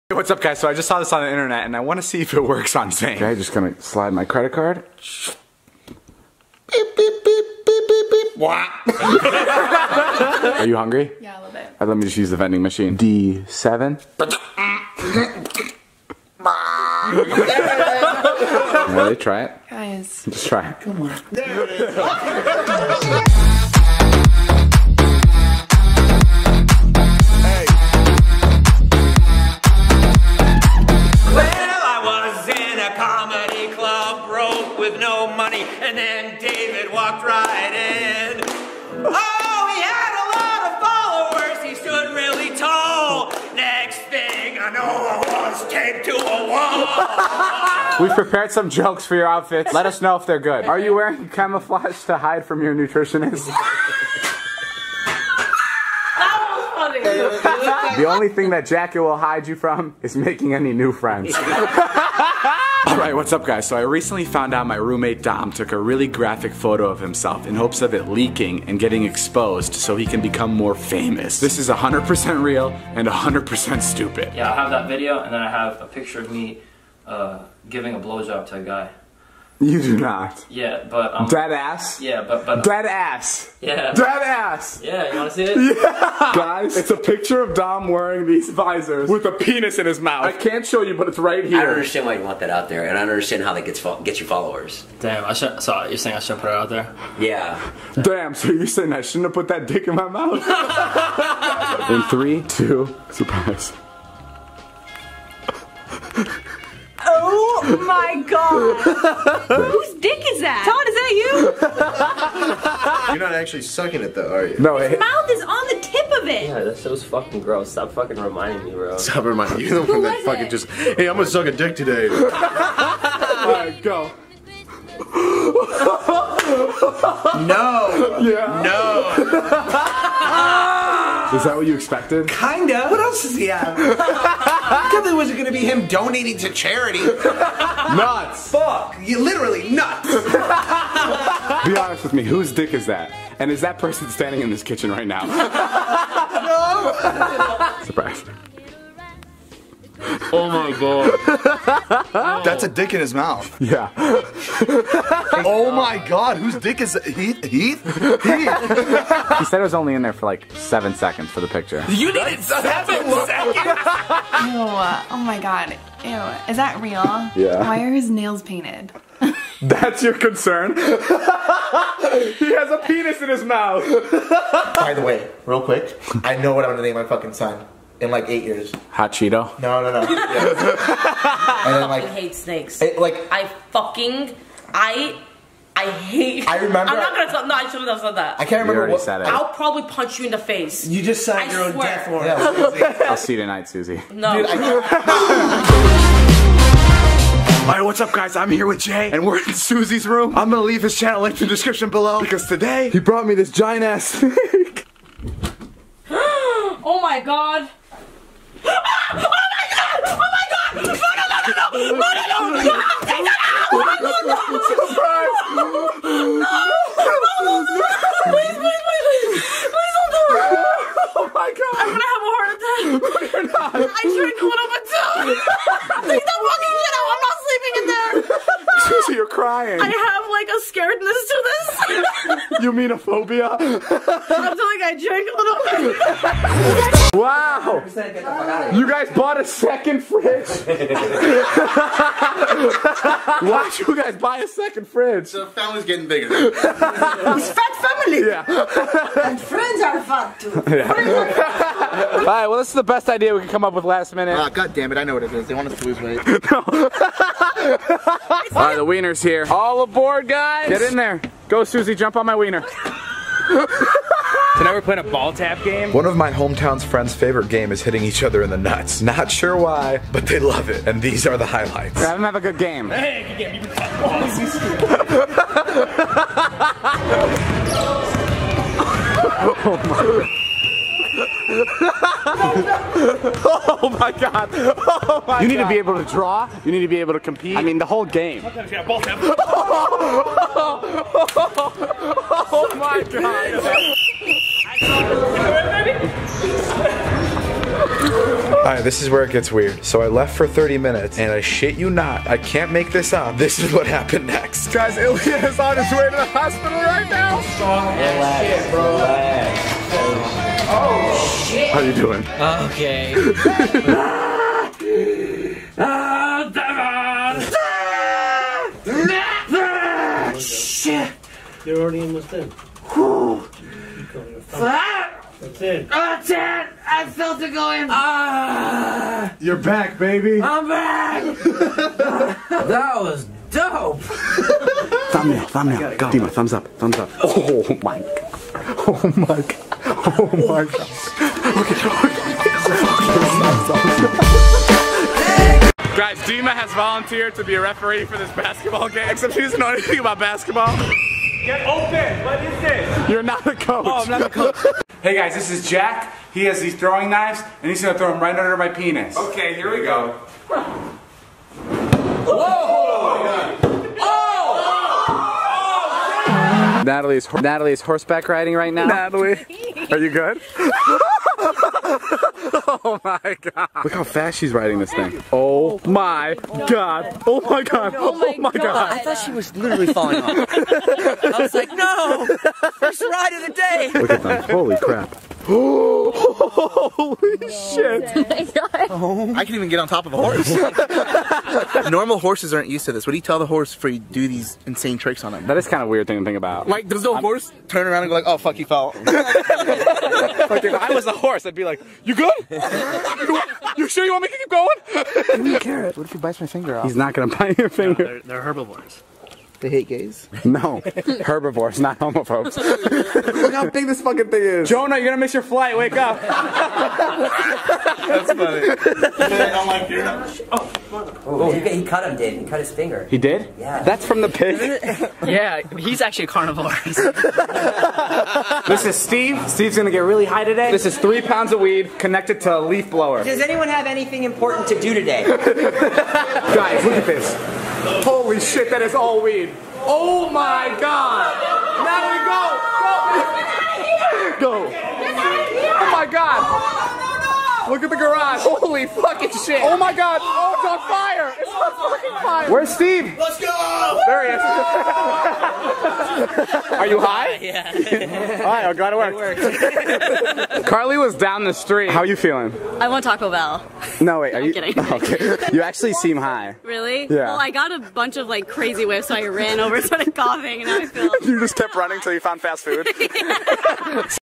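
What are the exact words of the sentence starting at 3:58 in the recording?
You guys bought a second fridge?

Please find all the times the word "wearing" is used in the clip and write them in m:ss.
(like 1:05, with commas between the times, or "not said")
0:50, 1:27.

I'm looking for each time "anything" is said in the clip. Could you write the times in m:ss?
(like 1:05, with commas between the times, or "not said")
5:49, 7:13.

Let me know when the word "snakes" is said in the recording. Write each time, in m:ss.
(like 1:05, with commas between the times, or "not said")
3:02, 3:24.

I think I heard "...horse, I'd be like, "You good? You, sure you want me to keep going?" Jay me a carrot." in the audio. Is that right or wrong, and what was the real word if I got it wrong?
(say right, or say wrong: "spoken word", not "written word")
wrong: "Give", not "Jay".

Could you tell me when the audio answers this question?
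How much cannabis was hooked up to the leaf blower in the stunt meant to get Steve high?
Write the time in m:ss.
7:10.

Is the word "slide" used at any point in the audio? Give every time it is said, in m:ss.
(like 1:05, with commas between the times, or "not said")
0:03.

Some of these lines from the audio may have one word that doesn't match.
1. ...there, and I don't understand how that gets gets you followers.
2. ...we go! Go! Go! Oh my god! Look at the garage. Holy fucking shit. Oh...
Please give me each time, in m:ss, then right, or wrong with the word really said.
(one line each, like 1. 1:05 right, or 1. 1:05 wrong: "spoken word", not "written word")
1. 1:32 right
2. 7:24 right.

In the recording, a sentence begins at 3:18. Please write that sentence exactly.
I'm here with Jay, and we're in Susie's room.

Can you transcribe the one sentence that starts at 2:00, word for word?
just, hey, I'm gonna suck a dick today.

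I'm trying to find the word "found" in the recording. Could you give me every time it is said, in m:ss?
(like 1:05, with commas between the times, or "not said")
1:04, 7:52.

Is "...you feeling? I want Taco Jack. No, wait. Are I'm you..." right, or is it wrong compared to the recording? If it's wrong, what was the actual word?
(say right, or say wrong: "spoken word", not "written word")
wrong: "Bell", not "Jack".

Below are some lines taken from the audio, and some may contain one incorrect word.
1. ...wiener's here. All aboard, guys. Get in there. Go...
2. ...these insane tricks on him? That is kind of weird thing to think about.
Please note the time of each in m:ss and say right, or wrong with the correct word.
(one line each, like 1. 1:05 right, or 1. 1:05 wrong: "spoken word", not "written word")
1. 4:18 right
2. 6:34 right.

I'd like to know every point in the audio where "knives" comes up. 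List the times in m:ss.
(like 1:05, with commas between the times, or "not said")
5:57.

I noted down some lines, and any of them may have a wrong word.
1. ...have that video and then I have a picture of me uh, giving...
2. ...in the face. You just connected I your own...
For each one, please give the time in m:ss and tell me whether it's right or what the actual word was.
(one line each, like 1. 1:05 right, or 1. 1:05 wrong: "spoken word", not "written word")
1. 1:14 right
2. 3:10 wrong: "signed", not "connected".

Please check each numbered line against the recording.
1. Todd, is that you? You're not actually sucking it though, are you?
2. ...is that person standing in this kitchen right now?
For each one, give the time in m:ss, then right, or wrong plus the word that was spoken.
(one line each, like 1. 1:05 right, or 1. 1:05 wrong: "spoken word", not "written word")
1. 1:50 right
2. 2:23 right.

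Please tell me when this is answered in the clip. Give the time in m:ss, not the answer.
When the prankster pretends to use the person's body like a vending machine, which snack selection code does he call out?
0:12.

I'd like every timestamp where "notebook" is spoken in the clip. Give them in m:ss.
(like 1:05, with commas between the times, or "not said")
not said.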